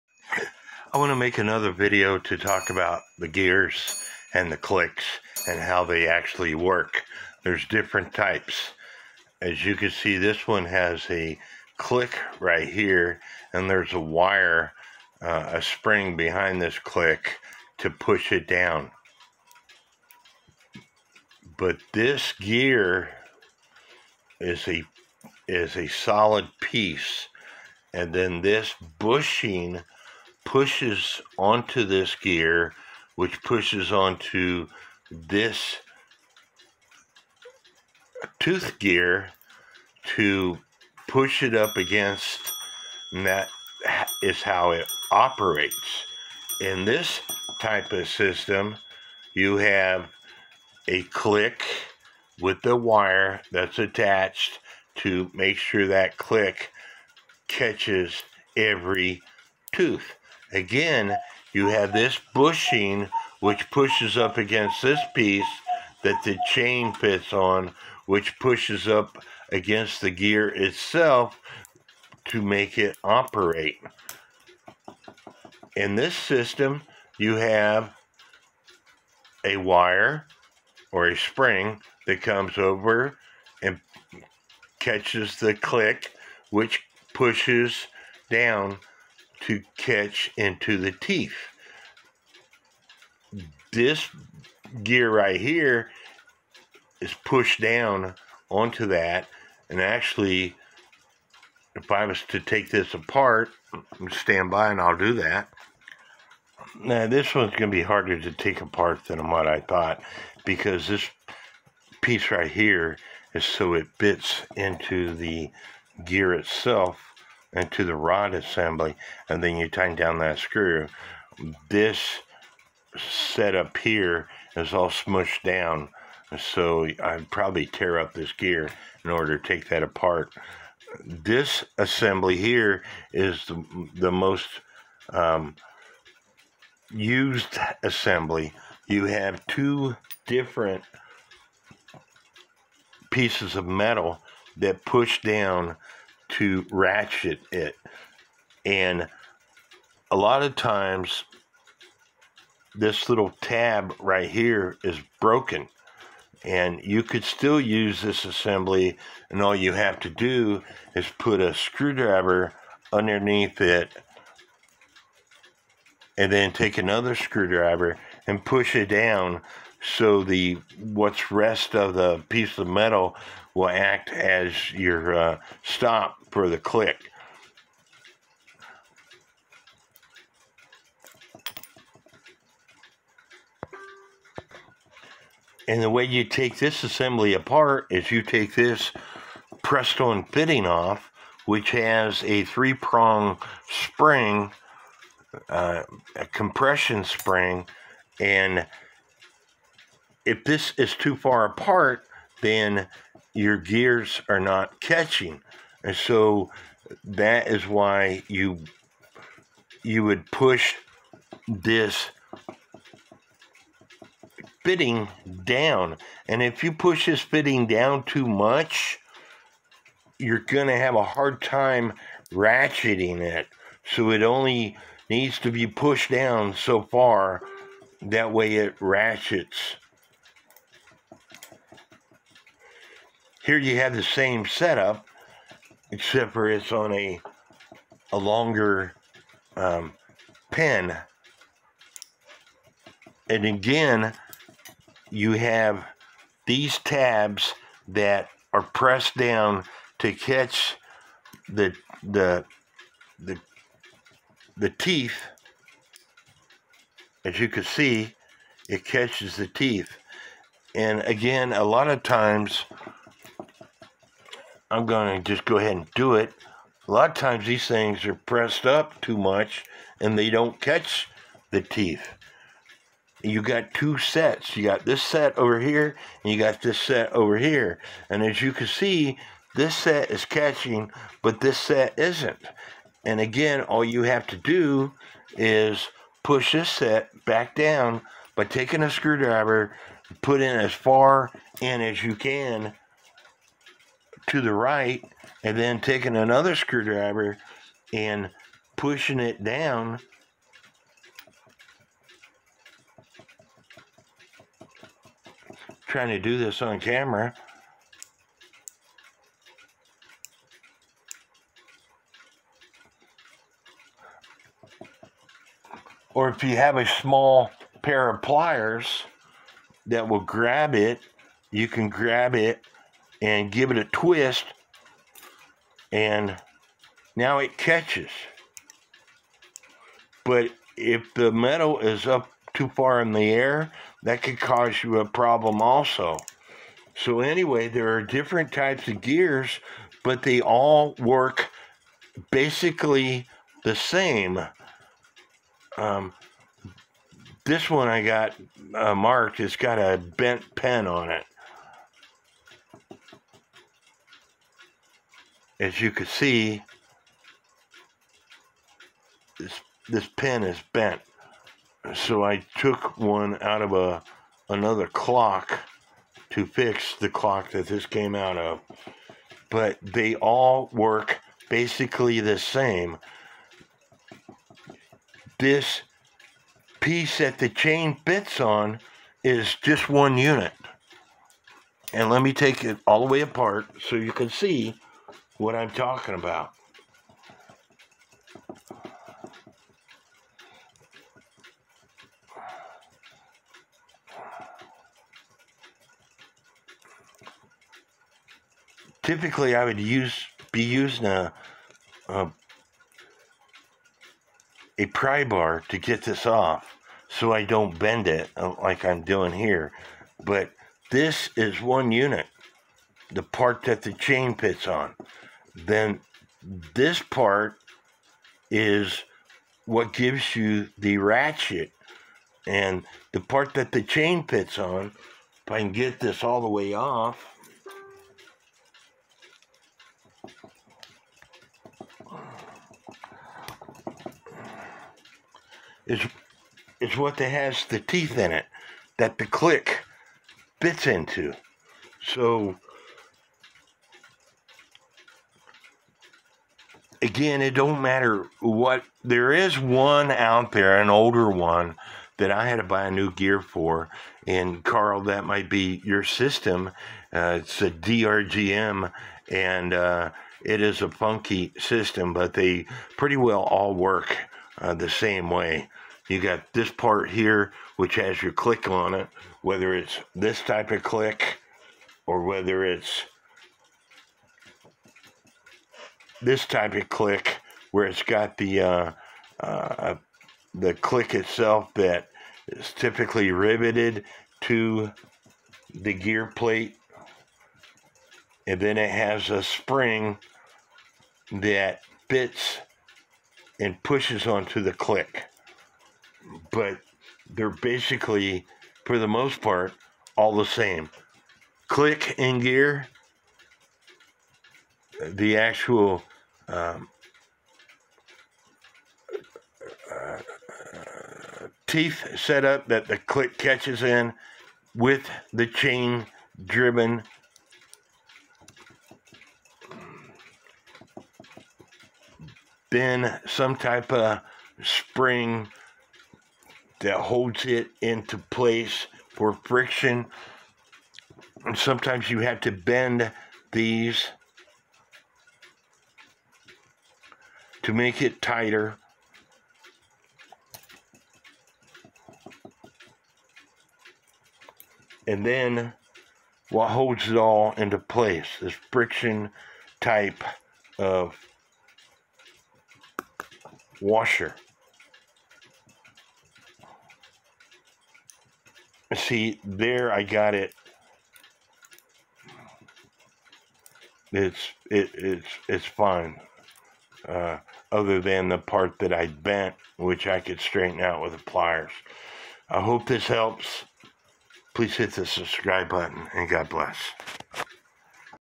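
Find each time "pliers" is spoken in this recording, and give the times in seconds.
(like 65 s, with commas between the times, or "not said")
318 s, 571 s.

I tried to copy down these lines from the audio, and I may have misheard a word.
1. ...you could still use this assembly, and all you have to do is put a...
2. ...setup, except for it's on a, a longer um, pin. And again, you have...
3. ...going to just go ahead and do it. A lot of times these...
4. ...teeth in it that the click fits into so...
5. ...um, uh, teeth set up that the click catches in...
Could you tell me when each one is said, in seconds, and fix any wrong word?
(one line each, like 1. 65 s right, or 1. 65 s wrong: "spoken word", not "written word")
1. 156 s right
2. 234 s right
3. 264 s right
4. 437 s right
5. 506 s right.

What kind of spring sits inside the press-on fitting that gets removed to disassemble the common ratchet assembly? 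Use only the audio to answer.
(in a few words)
three prong spring.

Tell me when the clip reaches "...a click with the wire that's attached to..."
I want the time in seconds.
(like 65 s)
50 s.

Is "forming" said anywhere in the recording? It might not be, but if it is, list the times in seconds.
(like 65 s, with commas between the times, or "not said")
not said.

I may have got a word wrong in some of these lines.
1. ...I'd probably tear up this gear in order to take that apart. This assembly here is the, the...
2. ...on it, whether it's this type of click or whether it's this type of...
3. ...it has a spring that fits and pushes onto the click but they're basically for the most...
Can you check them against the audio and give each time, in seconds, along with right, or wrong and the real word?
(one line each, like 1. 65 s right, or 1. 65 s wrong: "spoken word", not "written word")
1. 127 s right
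2. 468 s right
3. 488 s right.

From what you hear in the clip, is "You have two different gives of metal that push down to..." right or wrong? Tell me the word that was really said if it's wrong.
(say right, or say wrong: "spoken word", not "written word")
wrong: "pieces", not "gives".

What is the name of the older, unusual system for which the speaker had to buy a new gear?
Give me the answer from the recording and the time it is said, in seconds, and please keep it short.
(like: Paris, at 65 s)
DRGM, at 457 s.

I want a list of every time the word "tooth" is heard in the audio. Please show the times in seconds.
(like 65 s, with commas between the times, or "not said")
38 s, 59 s.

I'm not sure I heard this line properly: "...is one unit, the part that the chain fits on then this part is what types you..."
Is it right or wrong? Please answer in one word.
wrong.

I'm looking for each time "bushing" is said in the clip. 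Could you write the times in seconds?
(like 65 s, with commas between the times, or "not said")
28 s, 62 s.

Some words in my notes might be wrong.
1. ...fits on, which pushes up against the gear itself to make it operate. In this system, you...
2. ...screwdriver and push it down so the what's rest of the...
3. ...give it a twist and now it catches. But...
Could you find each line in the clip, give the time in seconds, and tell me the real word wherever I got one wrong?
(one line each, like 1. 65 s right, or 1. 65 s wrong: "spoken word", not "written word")
1. 66 s right
2. 167 s right
3. 323 s right.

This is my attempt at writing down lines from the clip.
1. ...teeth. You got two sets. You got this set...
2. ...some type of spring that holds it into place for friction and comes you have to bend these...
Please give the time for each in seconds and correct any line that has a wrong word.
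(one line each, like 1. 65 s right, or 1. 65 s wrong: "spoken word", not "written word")
1. 271 s right
2. 523 s wrong: "sometimes", not "comes".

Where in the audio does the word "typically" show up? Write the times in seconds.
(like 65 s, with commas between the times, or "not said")
399 s, 482 s.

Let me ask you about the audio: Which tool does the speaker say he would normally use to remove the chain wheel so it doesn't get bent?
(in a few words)
pry bar.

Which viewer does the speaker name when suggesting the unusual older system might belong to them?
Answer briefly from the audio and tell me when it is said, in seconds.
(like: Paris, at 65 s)
Carl, at 454 s.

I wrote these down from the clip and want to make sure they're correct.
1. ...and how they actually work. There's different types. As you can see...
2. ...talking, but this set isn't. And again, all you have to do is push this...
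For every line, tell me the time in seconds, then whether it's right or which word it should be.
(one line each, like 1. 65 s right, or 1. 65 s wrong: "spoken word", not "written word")
1. 5 s right
2. 280 s wrong: "catching", not "talking".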